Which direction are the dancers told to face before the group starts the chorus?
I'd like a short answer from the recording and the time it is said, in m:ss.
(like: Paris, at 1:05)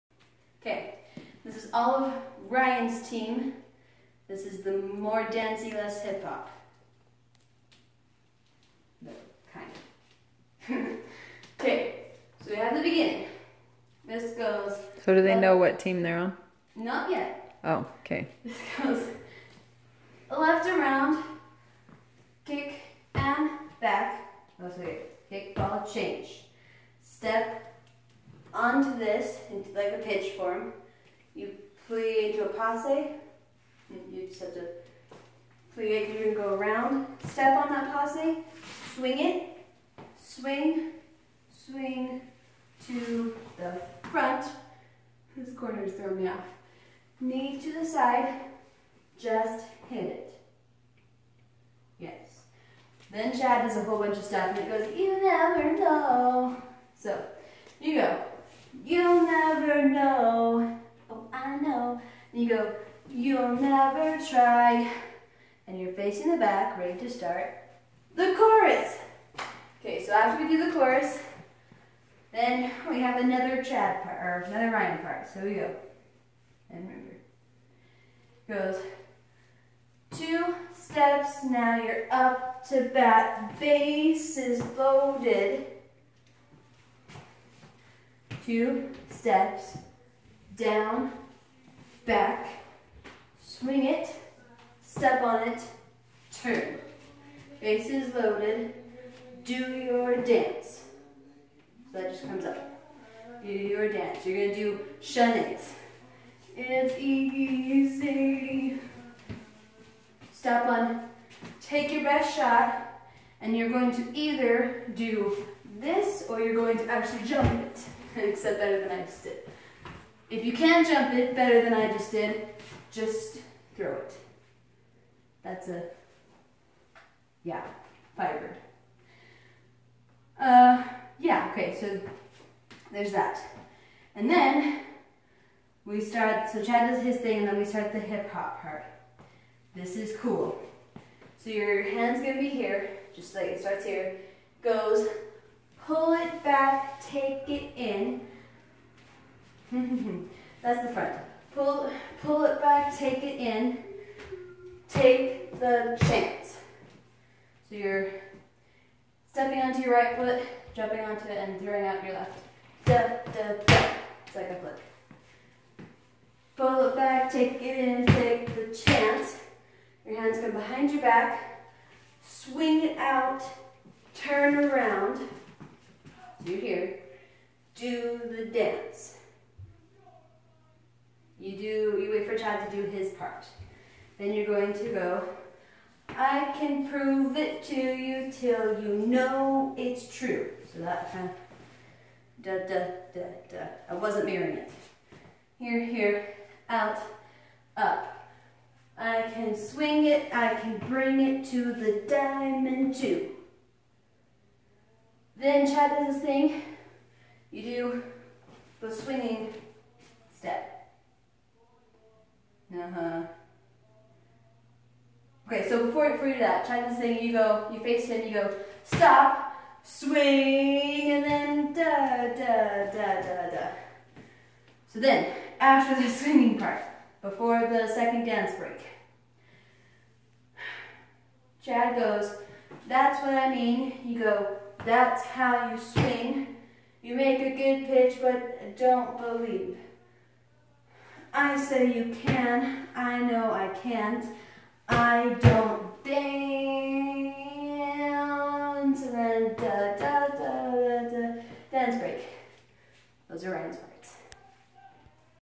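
the back, at 1:06.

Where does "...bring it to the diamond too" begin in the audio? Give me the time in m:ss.
3:20.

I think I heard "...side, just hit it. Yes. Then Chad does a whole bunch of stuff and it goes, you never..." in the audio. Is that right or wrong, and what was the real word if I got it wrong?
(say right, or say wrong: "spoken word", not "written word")
right.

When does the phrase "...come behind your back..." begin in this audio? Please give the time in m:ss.
2:50.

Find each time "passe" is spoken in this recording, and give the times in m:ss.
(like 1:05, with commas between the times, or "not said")
0:32, 0:37.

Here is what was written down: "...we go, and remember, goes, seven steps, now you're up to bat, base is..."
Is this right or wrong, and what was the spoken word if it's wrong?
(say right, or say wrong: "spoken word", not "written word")
wrong: "two", not "seven".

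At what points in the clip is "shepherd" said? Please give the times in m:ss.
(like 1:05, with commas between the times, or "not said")
not said.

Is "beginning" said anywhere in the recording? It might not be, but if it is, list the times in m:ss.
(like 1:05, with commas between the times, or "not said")
0:12.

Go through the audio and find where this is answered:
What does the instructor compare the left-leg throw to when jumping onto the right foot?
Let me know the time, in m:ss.
2:44.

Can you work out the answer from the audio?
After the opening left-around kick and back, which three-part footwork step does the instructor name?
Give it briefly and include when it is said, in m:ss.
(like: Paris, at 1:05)
kick ball change, at 0:25.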